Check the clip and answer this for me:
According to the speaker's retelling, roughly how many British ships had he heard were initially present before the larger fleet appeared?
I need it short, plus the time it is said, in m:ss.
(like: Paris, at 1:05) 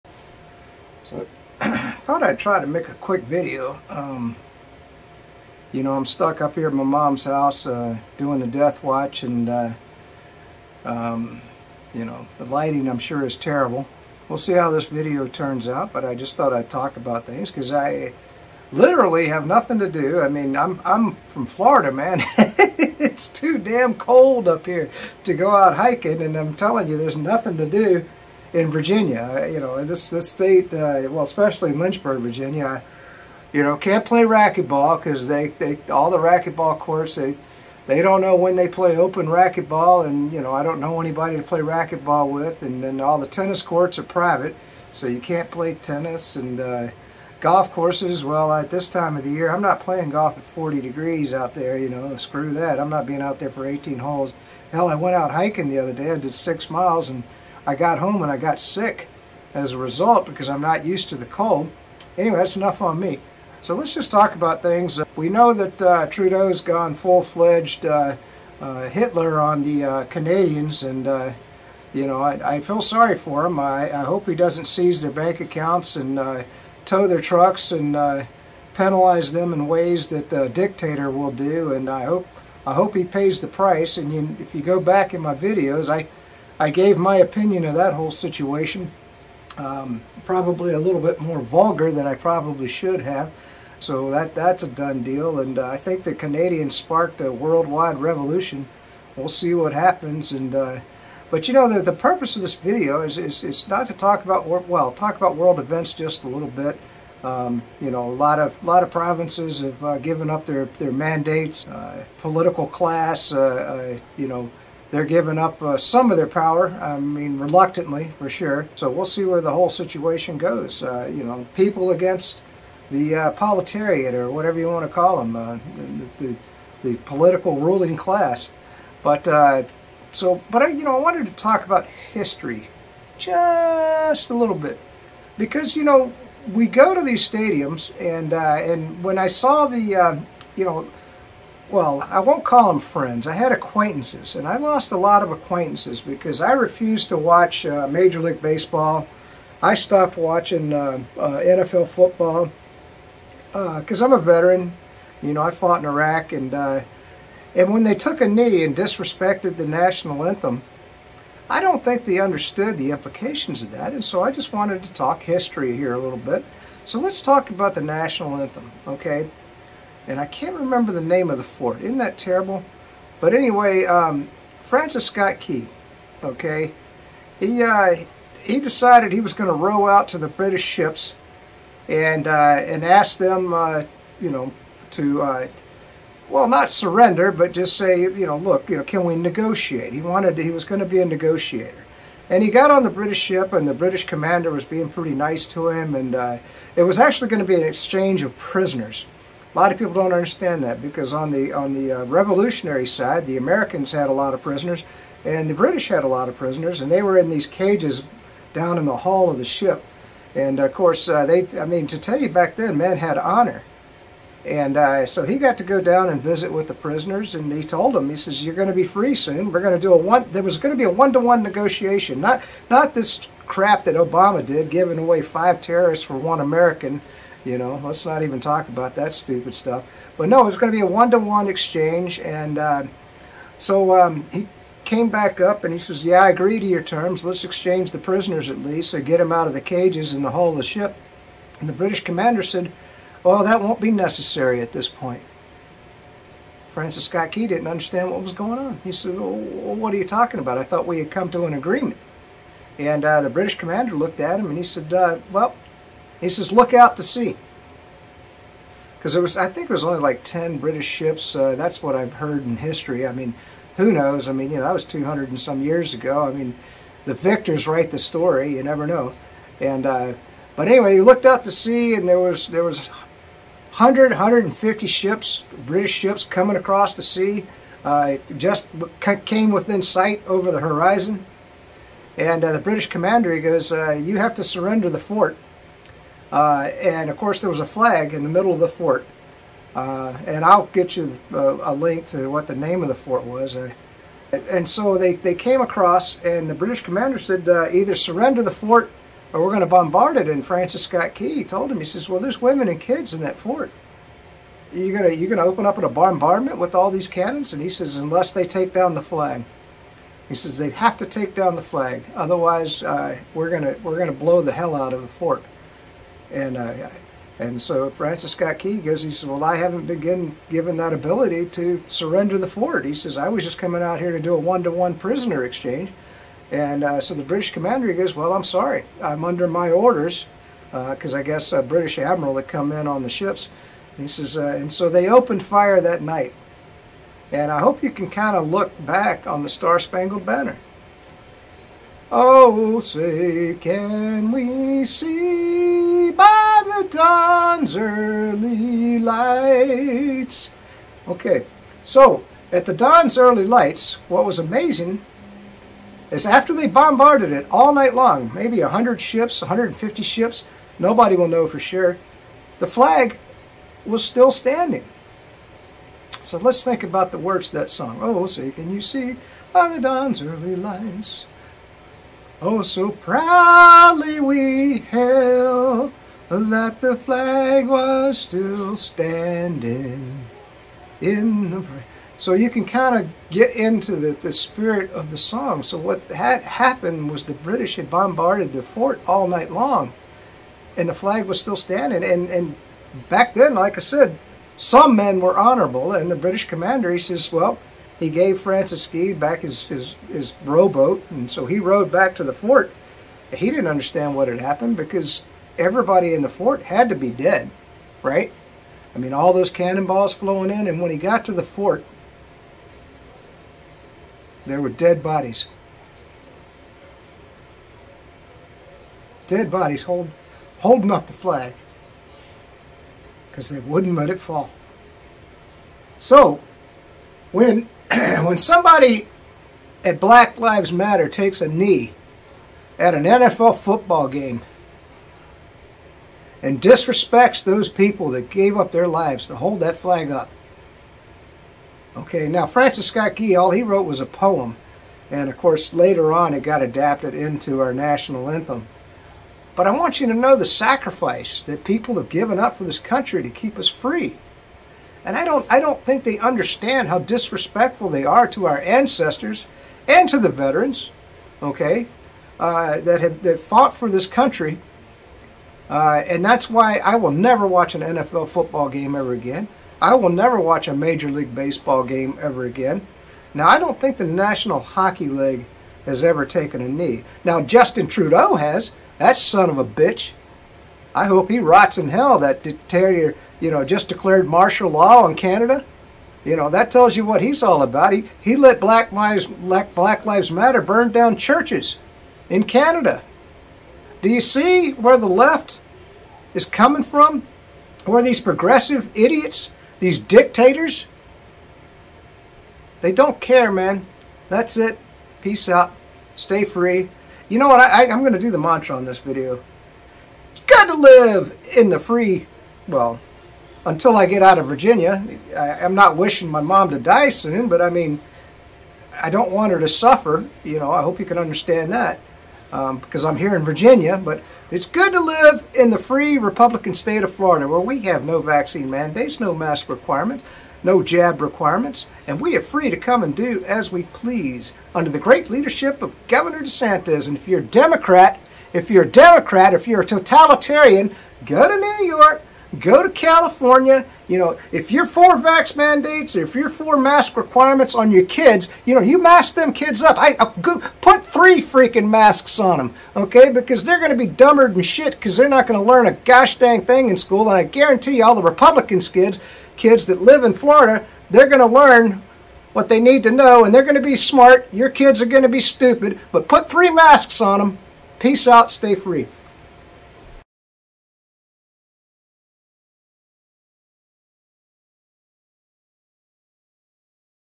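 10, at 4:20.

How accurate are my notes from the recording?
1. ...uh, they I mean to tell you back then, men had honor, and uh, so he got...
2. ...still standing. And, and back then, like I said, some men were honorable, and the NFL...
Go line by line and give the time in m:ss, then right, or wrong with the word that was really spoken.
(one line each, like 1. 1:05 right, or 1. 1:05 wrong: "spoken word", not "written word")
1. 3:31 right
2. 6:31 wrong: "British", not "NFL".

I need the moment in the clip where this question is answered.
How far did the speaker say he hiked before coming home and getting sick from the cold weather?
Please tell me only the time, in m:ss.
0:56.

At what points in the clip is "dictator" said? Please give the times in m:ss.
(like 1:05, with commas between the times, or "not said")
1:20, 8:02, 8:19.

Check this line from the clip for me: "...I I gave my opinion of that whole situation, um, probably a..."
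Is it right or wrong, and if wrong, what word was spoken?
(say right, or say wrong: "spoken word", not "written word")
right.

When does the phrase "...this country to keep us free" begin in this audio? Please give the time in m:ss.
7:32.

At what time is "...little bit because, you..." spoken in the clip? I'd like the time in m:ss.
2:14.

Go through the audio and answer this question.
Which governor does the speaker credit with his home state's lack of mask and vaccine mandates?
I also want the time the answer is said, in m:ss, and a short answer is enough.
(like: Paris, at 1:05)
Governor DeSantis, at 8:56.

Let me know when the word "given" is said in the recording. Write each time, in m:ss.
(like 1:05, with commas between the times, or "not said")
1:49, 5:20, 7:32.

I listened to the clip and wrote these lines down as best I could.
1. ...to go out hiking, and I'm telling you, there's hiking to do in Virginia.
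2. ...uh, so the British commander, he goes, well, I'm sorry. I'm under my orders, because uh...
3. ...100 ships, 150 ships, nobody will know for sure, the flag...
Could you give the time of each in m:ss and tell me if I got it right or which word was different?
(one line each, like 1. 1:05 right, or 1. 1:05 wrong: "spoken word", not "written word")
1. 0:25 wrong: "nothing", not "hiking"
2. 5:26 right
3. 5:58 right.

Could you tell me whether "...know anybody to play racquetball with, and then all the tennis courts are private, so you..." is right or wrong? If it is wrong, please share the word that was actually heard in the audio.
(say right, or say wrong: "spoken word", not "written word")
right.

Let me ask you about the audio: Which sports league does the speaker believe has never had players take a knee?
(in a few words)
National Hockey League.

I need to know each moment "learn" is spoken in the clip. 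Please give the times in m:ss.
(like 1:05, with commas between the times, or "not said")
9:15, 9:21.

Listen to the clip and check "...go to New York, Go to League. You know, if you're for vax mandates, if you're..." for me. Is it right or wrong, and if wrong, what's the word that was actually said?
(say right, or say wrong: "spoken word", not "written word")
wrong: "California", not "League".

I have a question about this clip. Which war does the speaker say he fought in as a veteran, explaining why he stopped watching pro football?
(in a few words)
Iraq.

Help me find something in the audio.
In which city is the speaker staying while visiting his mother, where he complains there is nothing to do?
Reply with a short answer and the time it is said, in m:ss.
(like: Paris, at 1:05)
Lynchburg, Virginia, at 0:31.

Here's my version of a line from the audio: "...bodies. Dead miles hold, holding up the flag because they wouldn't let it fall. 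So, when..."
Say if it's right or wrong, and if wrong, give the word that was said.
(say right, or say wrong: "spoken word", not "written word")
wrong: "bodies", not "miles".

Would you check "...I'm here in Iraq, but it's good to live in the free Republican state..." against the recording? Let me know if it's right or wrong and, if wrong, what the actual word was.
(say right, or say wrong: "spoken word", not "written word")
wrong: "Virginia", not "Iraq".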